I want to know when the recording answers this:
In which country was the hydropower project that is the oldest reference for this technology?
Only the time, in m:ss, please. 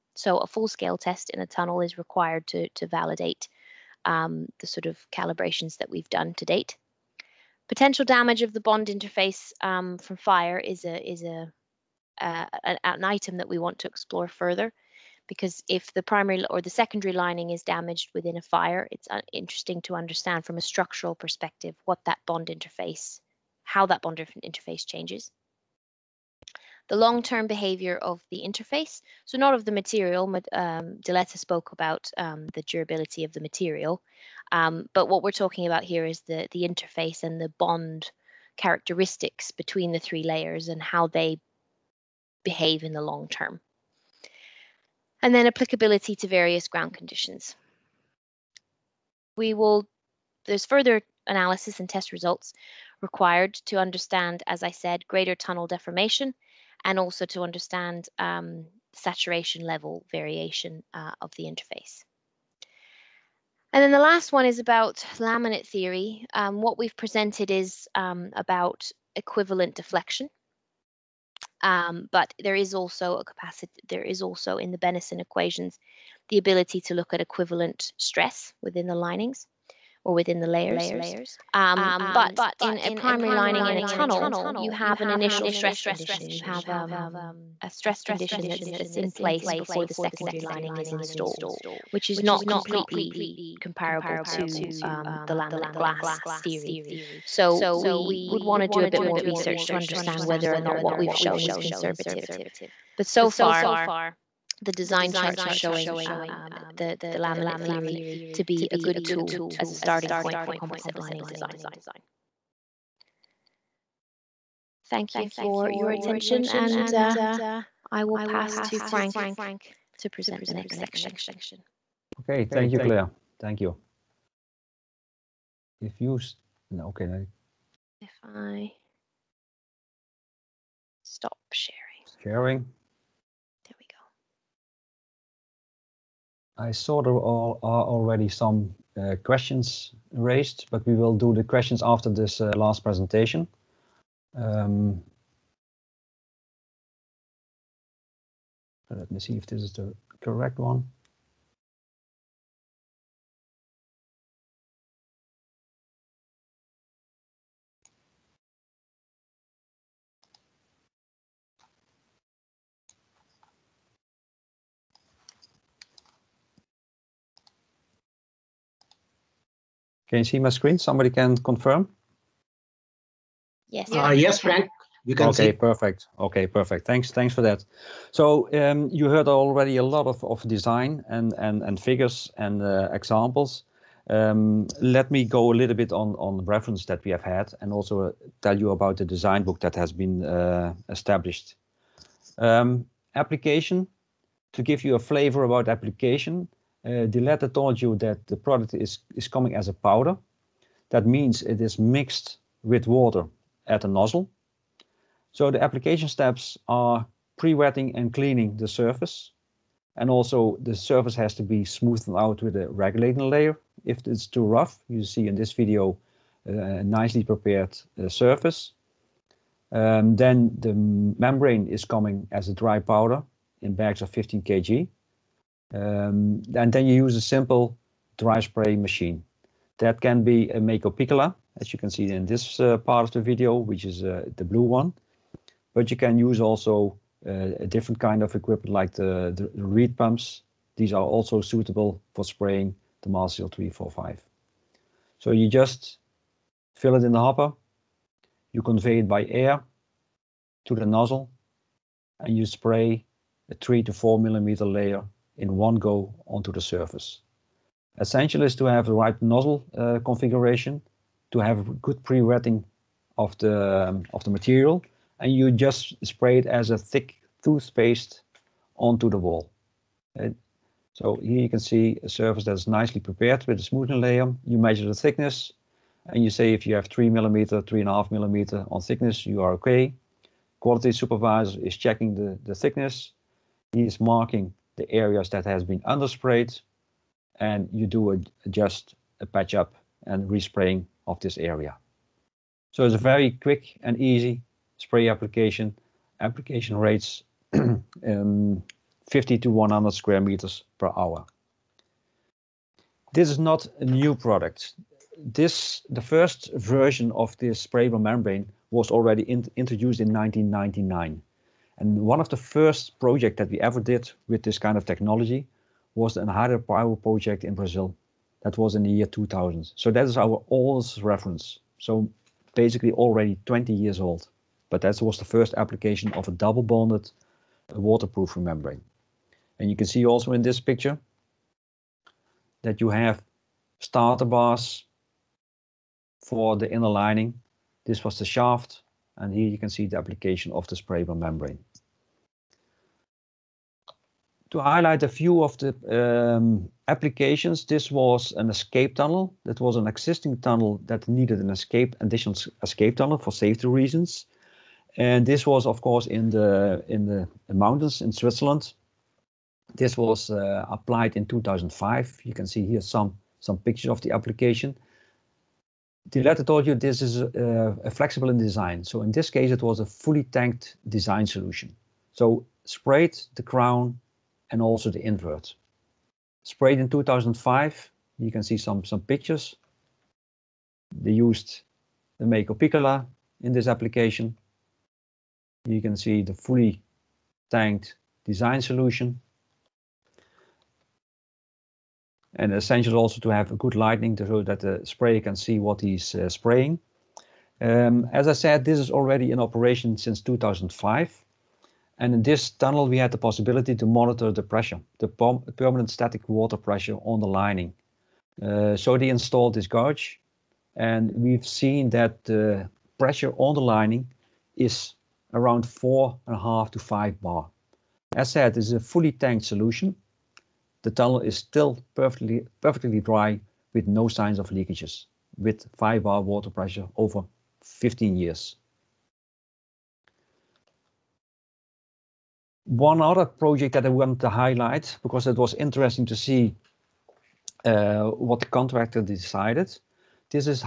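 5:17.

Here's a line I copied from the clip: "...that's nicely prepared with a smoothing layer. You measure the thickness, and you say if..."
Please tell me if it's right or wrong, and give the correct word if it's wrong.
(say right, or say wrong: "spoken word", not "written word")
right.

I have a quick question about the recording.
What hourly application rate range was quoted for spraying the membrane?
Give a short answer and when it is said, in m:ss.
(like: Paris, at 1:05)
50 to 100 square meters, at 4:59.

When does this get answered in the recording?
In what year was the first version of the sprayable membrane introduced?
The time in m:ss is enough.
5:10.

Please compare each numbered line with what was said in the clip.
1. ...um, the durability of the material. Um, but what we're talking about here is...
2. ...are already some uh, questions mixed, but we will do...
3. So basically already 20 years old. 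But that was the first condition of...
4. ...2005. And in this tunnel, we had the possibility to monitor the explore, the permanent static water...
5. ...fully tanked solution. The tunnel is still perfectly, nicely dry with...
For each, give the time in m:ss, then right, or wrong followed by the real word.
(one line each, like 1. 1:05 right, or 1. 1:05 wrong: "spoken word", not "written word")
1. 0:32 right
2. 2:17 wrong: "raised", not "mixed"
3. 5:21 wrong: "application", not "condition"
4. 6:40 wrong: "pressure", not "explore"
5. 6:58 wrong: "perfectly", not "nicely".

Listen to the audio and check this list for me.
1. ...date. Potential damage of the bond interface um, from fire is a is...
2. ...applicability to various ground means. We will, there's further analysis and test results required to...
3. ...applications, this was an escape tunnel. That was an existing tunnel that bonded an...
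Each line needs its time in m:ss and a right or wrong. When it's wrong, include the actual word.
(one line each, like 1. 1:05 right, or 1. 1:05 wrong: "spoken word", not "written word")
1. 0:06 right
2. 0:45 wrong: "conditions", not "means"
3. 5:46 wrong: "needed", not "bonded".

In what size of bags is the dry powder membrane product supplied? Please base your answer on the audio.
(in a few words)
15 kg.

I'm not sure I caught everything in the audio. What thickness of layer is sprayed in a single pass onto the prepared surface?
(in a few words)
3 to 4 millimeters.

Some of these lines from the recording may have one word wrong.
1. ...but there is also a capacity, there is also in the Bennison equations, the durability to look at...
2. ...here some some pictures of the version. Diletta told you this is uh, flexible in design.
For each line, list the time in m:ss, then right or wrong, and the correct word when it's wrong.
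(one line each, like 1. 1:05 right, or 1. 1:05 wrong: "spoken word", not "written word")
1. 1:12 wrong: "ability", not "durability"
2. 6:02 wrong: "application", not "version".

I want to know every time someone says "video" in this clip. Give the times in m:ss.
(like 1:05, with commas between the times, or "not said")
3:35, 3:53.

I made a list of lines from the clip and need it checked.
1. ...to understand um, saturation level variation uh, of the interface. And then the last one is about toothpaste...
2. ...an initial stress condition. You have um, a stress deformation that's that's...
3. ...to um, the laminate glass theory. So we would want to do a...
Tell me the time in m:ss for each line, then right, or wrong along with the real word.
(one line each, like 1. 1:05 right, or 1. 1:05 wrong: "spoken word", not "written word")
1. 0:57 wrong: "laminate", not "toothpaste"
2. 1:25 wrong: "condition", not "deformation"
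3. 1:34 right.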